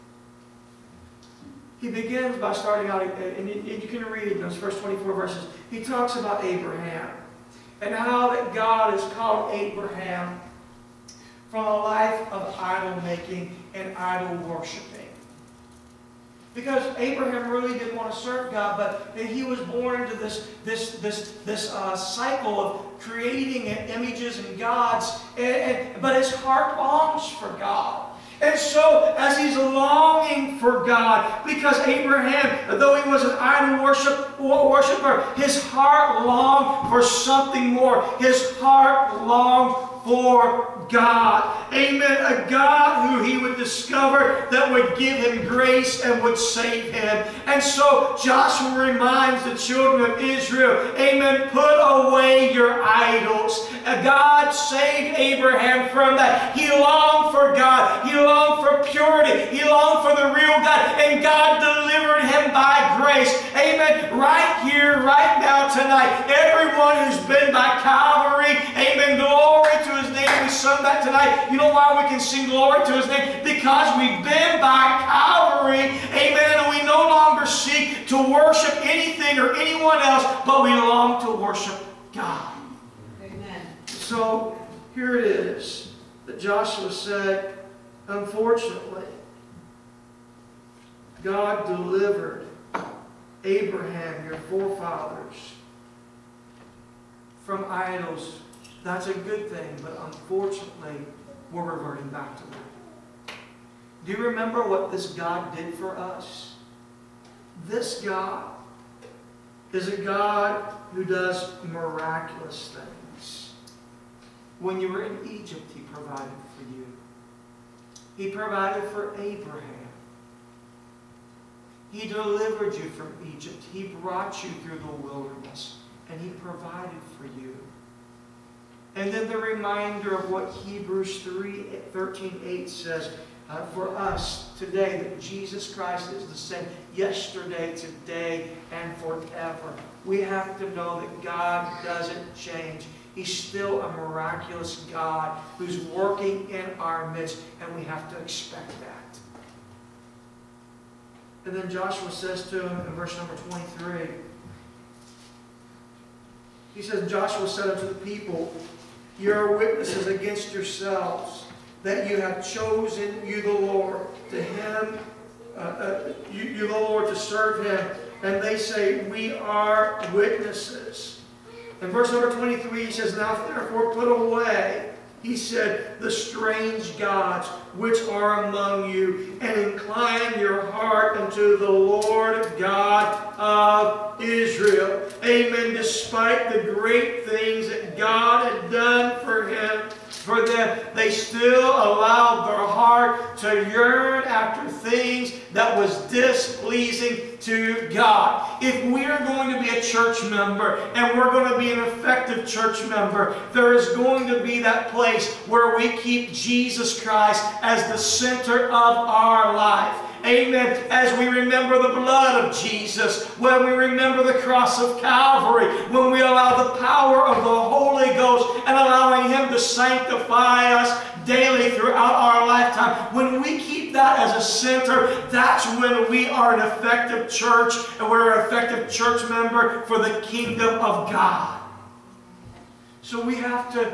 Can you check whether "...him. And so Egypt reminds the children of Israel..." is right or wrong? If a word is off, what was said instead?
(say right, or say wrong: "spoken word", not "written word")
wrong: "Joshua", not "Egypt".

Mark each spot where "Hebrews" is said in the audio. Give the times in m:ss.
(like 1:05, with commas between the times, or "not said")
2:10.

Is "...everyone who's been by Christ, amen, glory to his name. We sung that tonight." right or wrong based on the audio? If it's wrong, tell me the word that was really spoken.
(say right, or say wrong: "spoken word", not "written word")
wrong: "Calvary", not "Christ".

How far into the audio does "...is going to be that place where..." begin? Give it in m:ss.
3:23.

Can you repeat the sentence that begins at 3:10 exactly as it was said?
They still allowed their heart to yearn after things that was displeasing to God.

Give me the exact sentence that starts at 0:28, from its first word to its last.
And so, as he's longing for God, because Abraham, though he was an idol worship, worshiper, his heart longed for something more.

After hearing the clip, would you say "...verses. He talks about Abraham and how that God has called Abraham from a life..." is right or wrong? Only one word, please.
right.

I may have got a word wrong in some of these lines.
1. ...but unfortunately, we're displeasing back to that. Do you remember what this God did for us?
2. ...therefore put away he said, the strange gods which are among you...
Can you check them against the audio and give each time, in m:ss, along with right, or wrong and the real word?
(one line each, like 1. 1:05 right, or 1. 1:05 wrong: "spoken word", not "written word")
1. 1:39 wrong: "reverting", not "displeasing"
2. 2:53 right.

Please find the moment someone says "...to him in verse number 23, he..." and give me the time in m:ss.
2:32.